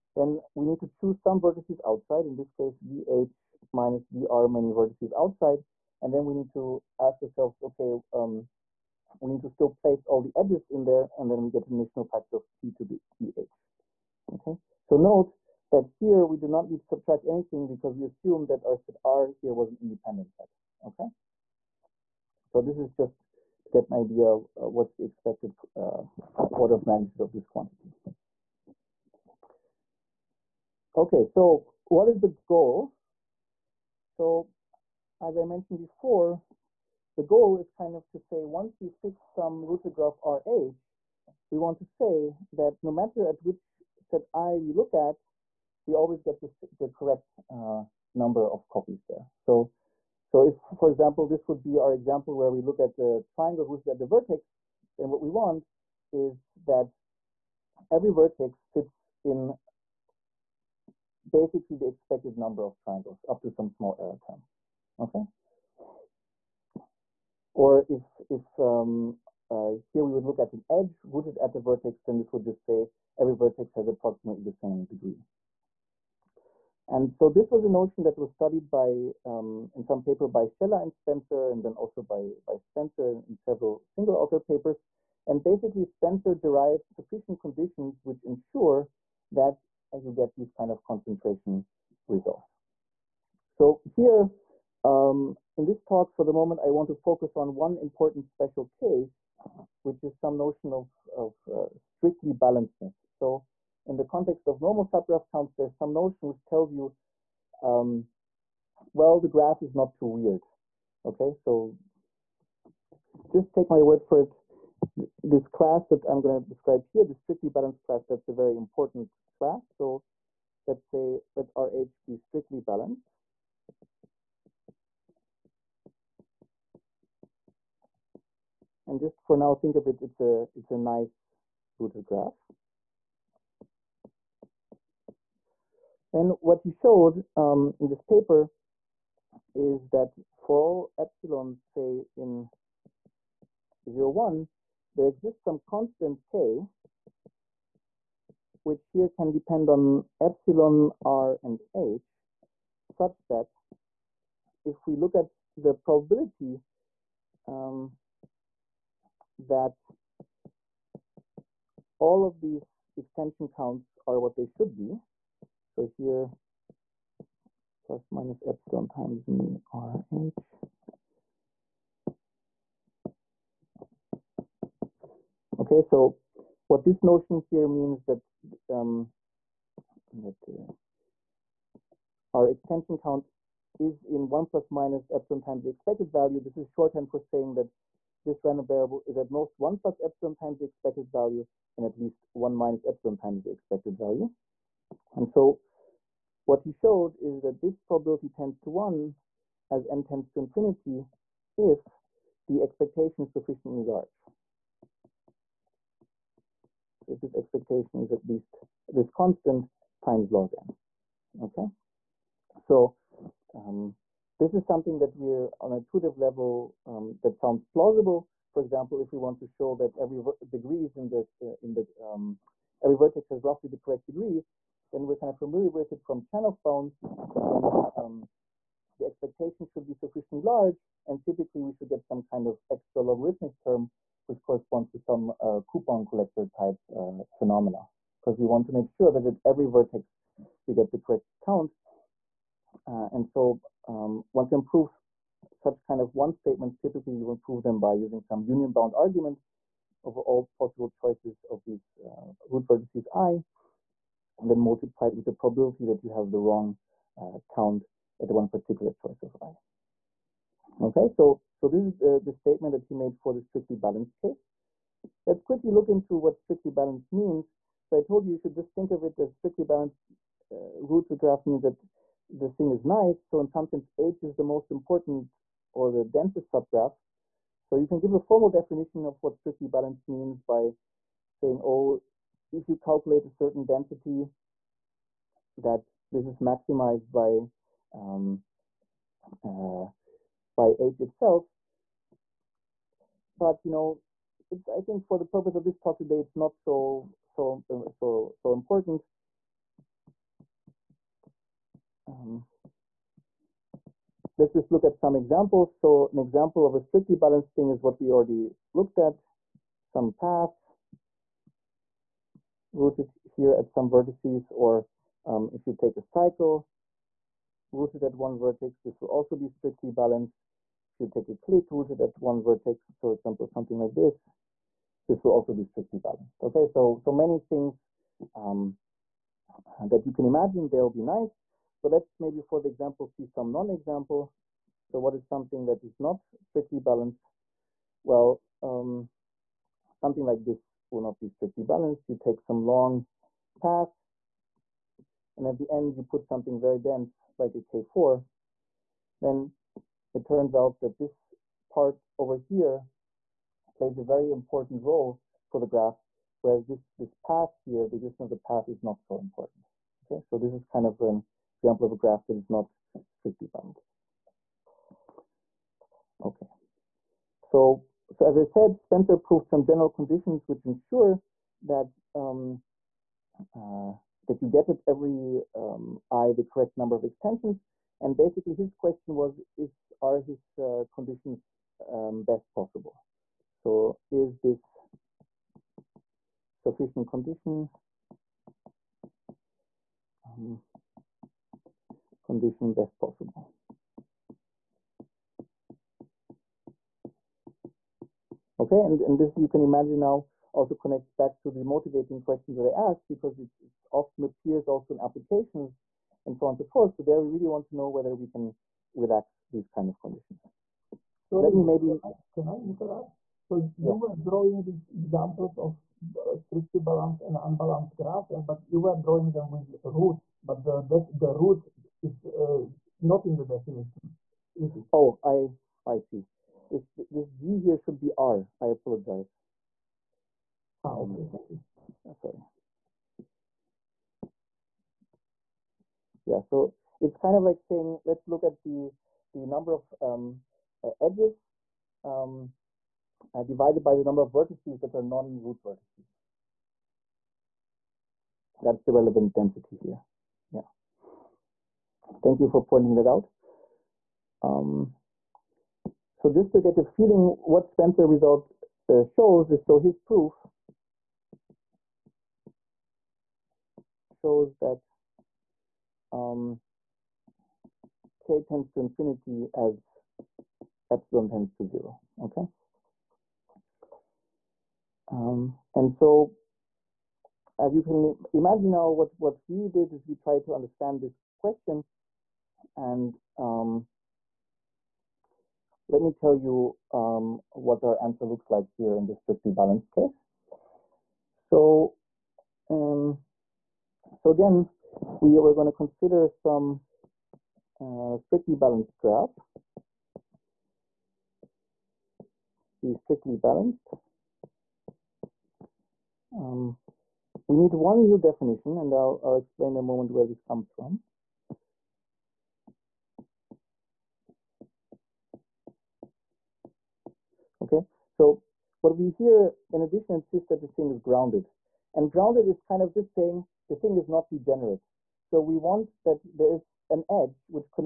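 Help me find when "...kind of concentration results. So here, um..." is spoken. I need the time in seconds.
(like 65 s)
90 s.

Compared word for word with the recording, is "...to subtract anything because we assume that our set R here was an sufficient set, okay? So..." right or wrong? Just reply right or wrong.
wrong.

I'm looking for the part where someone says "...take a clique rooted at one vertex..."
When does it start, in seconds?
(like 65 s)
321 s.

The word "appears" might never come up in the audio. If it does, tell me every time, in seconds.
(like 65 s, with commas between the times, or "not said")
404 s.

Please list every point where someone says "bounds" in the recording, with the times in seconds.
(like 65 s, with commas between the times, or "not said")
226 s, 248 s.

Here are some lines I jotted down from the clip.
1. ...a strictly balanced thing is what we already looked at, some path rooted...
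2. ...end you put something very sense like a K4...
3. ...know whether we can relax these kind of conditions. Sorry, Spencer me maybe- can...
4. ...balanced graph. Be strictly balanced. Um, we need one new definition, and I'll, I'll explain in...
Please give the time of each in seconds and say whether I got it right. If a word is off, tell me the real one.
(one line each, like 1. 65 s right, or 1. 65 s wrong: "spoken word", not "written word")
1. 306 s right
2. 345 s wrong: "dense", not "sense"
3. 407 s wrong: "Let", not "Spencer"
4. 498 s right.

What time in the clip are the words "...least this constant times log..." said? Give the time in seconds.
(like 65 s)
208 s.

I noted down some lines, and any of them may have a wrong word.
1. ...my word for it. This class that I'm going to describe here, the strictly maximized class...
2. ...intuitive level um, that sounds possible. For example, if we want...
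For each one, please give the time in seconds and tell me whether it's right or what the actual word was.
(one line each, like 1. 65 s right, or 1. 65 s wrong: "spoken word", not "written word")
1. 113 s wrong: "balanced", not "maximized"
2. 215 s wrong: "plausible", not "possible".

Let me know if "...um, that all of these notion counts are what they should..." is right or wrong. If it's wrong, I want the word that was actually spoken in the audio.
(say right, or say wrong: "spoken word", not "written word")
wrong: "extension", not "notion".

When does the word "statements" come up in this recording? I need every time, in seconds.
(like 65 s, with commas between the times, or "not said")
246 s, 262 s.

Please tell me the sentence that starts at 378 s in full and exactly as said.
And basically his question was, is are his uh, conditions um, best possible?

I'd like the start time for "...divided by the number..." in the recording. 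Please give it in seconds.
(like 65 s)
443 s.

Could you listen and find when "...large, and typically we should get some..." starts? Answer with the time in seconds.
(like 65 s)
230 s.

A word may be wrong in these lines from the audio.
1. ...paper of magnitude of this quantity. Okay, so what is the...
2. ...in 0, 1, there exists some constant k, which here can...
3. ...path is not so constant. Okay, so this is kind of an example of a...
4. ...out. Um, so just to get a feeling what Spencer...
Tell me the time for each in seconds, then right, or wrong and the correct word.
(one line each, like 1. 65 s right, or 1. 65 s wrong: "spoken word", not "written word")
1. 26 s wrong: "order", not "paper"
2. 142 s right
3. 358 s wrong: "important", not "constant"
4. 453 s right.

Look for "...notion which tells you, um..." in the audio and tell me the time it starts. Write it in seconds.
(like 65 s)
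105 s.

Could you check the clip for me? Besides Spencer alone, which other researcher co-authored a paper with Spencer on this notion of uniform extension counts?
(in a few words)
Shelah.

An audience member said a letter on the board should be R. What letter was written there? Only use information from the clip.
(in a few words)
G.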